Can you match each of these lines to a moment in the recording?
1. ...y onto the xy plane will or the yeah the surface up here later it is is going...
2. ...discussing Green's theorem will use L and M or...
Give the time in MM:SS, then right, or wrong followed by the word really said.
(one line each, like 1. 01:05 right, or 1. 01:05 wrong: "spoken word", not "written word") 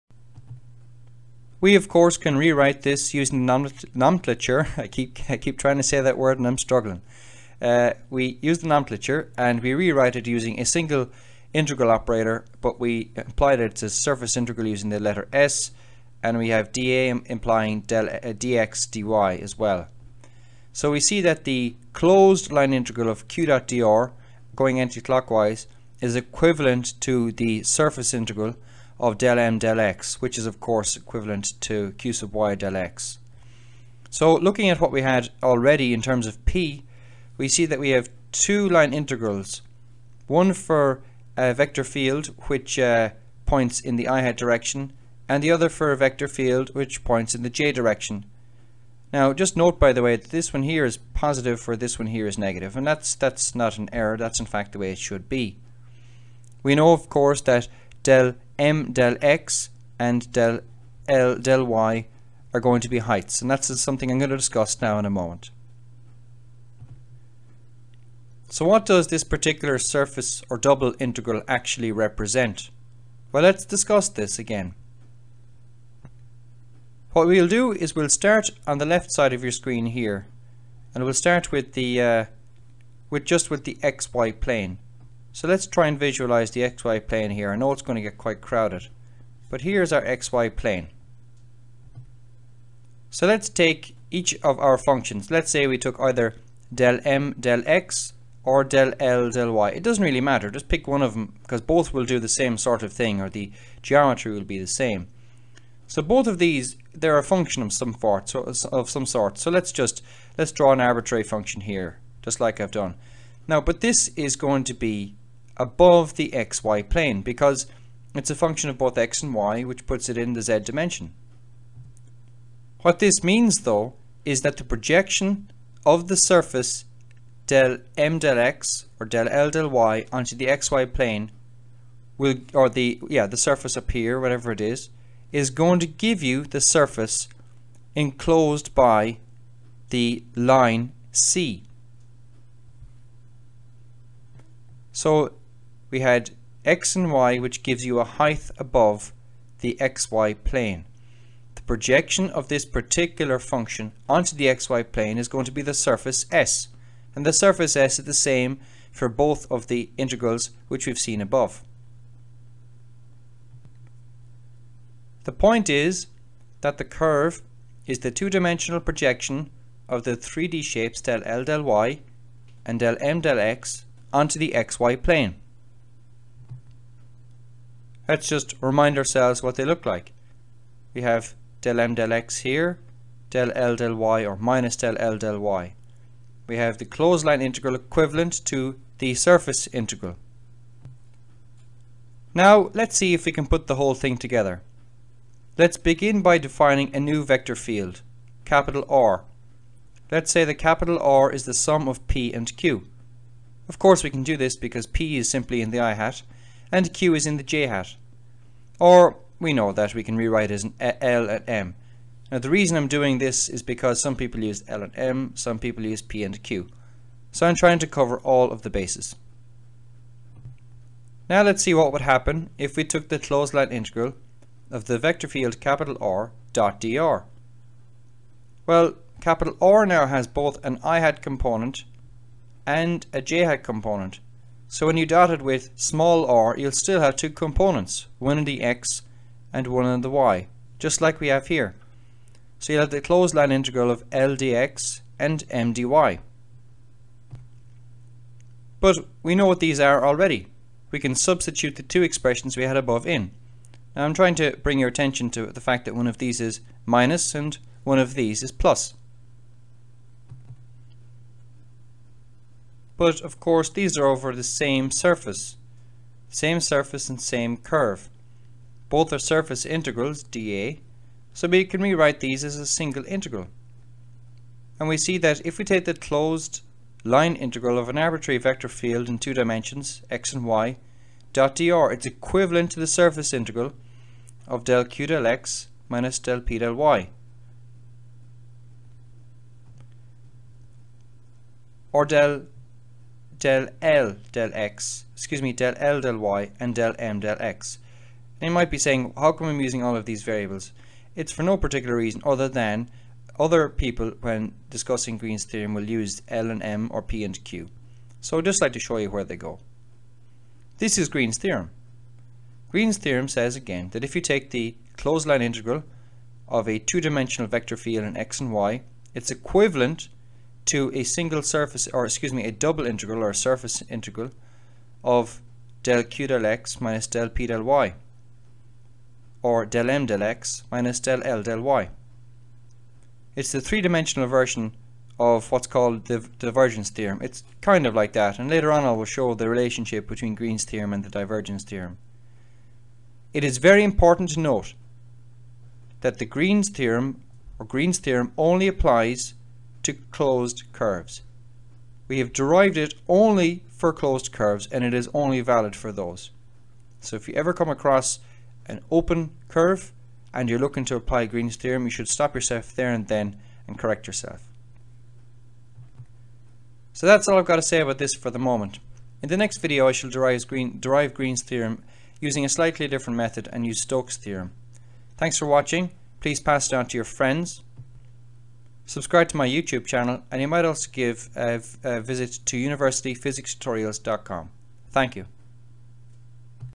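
1. 02:09 wrong: "whatever", not "later"
2. 05:04 right.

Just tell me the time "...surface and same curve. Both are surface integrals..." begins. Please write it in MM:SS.
04:26.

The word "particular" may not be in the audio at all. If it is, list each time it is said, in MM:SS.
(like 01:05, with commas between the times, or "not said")
01:09, 02:32, 05:01.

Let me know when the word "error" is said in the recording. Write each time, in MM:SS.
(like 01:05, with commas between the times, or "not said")
00:53.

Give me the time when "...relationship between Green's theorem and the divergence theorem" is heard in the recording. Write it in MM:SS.
05:39.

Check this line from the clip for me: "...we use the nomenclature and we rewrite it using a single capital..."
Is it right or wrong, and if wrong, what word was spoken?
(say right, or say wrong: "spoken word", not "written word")
wrong: "integral", not "capital".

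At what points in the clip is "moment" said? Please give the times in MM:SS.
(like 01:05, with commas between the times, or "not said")
01:05, 06:08.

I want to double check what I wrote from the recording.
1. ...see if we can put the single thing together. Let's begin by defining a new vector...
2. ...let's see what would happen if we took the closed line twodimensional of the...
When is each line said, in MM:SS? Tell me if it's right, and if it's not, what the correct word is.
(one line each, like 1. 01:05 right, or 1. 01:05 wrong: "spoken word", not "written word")
1. 03:12 wrong: "whole", not "single"
2. 03:41 wrong: "integral", not "twodimensional".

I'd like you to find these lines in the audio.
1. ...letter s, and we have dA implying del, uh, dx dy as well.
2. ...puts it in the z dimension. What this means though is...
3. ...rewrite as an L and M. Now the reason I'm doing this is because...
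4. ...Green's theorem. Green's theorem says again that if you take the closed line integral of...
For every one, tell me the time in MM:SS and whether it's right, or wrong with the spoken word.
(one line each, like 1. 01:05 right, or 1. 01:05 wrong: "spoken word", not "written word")
1. 00:14 right
2. 01:59 right
3. 03:30 right
4. 05:11 right.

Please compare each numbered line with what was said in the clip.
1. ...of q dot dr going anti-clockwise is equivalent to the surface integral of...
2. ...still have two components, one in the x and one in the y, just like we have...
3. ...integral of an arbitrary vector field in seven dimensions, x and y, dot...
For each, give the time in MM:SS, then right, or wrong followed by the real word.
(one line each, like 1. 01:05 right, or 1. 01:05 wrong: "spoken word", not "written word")
1. 00:23 right
2. 03:56 right
3. 04:37 wrong: "two", not "seven".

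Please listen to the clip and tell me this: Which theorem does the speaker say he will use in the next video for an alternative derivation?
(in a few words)
Stokes' theorem.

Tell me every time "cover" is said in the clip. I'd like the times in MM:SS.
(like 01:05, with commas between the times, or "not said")
03:37.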